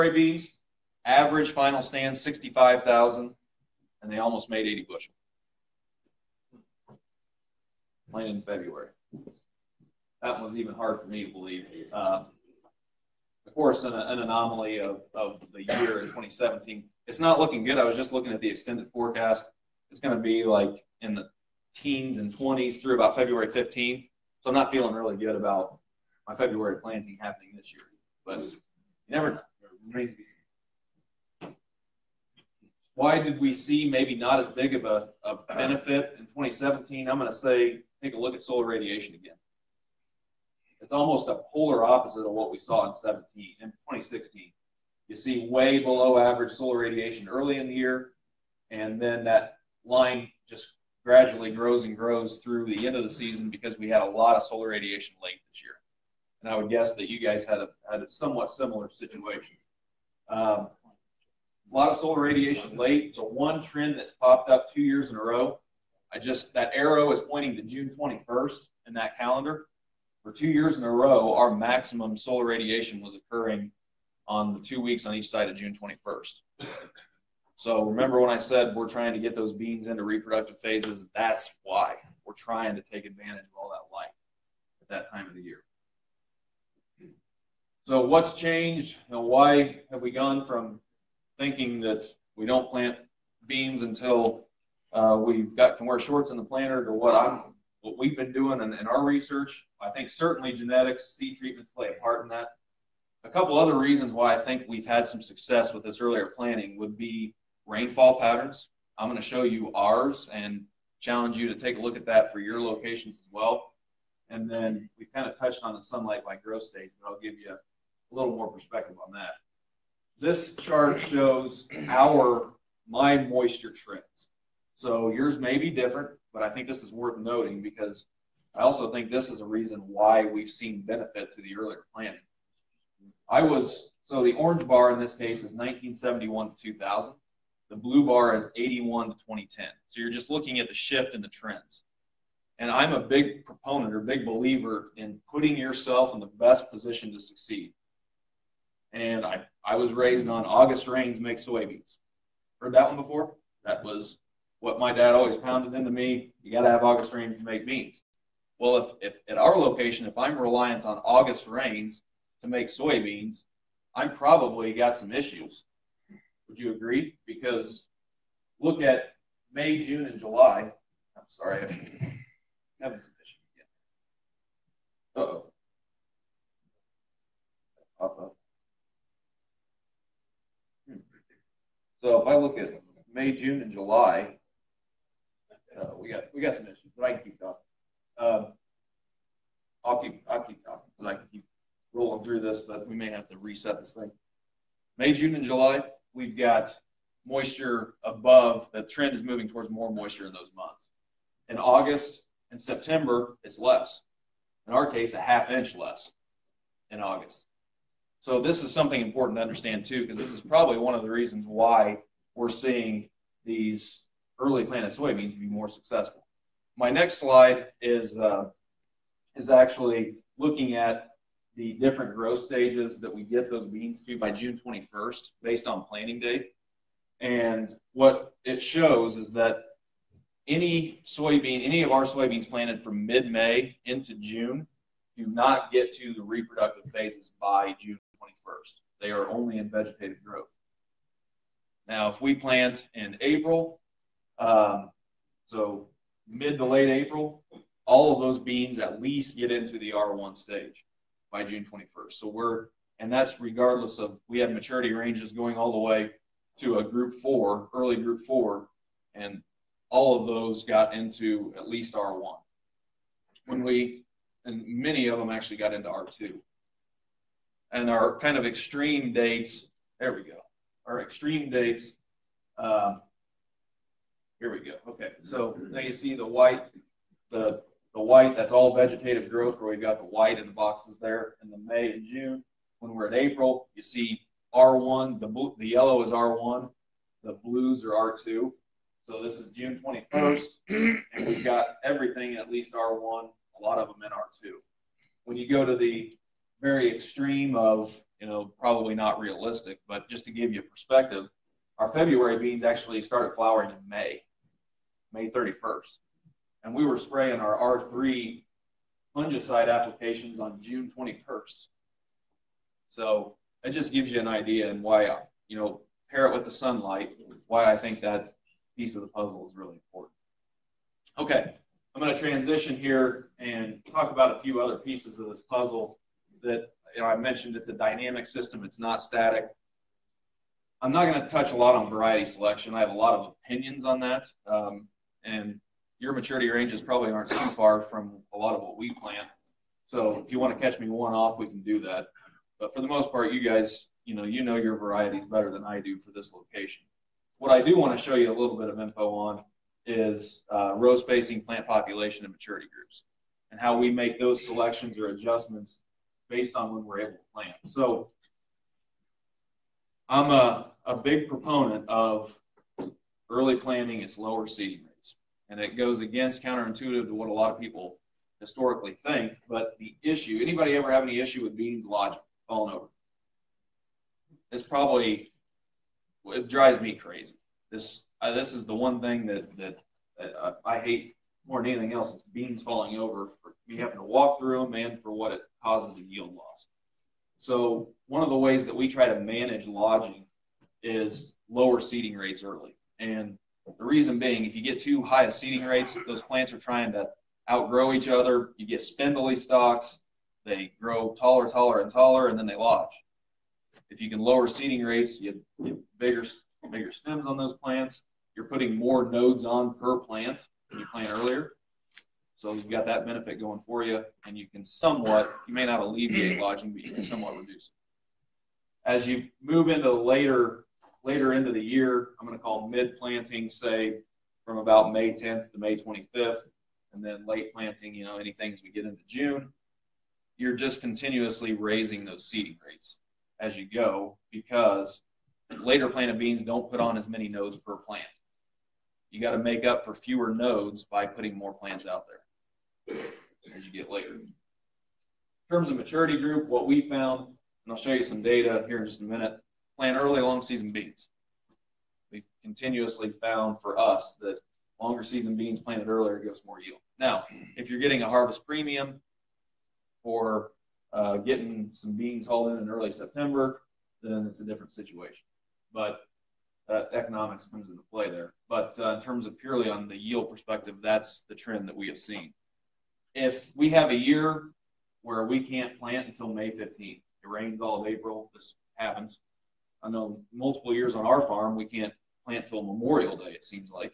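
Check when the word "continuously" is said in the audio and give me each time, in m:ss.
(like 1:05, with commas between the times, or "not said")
7:10, 7:32.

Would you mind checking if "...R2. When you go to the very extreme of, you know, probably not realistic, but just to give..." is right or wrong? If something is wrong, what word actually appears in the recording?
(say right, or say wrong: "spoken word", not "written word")
right.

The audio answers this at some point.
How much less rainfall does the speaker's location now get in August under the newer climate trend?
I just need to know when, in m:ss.
3:25.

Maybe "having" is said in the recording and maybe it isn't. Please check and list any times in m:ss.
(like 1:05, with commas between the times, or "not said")
2:52, 6:23.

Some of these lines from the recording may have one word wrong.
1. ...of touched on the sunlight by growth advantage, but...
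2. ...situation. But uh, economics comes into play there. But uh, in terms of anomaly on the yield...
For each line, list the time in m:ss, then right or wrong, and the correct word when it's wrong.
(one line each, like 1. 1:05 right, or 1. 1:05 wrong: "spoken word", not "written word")
1. 1:55 wrong: "stage", not "advantage"
2. 7:44 wrong: "purely", not "anomaly".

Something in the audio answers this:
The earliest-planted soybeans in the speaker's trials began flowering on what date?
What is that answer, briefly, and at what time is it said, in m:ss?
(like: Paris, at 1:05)
May 31st, at 5:05.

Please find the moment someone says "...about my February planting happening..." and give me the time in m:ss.
0:25.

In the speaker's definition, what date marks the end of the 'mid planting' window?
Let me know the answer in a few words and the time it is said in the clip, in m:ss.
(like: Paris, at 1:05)
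May 25th, at 7:05.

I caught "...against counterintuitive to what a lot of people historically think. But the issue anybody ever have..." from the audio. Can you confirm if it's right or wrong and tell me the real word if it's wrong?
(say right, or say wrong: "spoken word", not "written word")
right.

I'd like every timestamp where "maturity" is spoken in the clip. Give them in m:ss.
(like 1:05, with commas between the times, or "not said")
4:14, 5:36, 5:52, 7:25.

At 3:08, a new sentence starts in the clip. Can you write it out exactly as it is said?
Um, I'll keep I'll keep talking because I can keep rolling through this, but we may have to reset this thing.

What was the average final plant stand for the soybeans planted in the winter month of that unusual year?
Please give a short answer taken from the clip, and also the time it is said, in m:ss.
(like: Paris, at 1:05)
65,000, at 0:02.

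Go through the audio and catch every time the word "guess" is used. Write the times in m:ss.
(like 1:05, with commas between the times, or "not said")
0:56.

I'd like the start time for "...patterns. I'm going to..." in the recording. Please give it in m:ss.
1:48.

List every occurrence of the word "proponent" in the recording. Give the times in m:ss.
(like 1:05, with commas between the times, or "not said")
2:23, 6:01.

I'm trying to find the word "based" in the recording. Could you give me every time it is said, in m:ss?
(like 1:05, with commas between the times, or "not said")
3:45, 5:56.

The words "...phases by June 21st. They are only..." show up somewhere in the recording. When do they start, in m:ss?
3:56.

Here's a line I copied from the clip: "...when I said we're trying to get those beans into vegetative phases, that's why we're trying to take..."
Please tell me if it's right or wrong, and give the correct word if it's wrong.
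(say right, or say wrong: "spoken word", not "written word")
wrong: "reproductive", not "vegetative".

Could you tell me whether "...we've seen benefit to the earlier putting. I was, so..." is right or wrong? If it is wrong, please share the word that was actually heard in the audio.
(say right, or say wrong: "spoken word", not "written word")
wrong: "planting", not "putting".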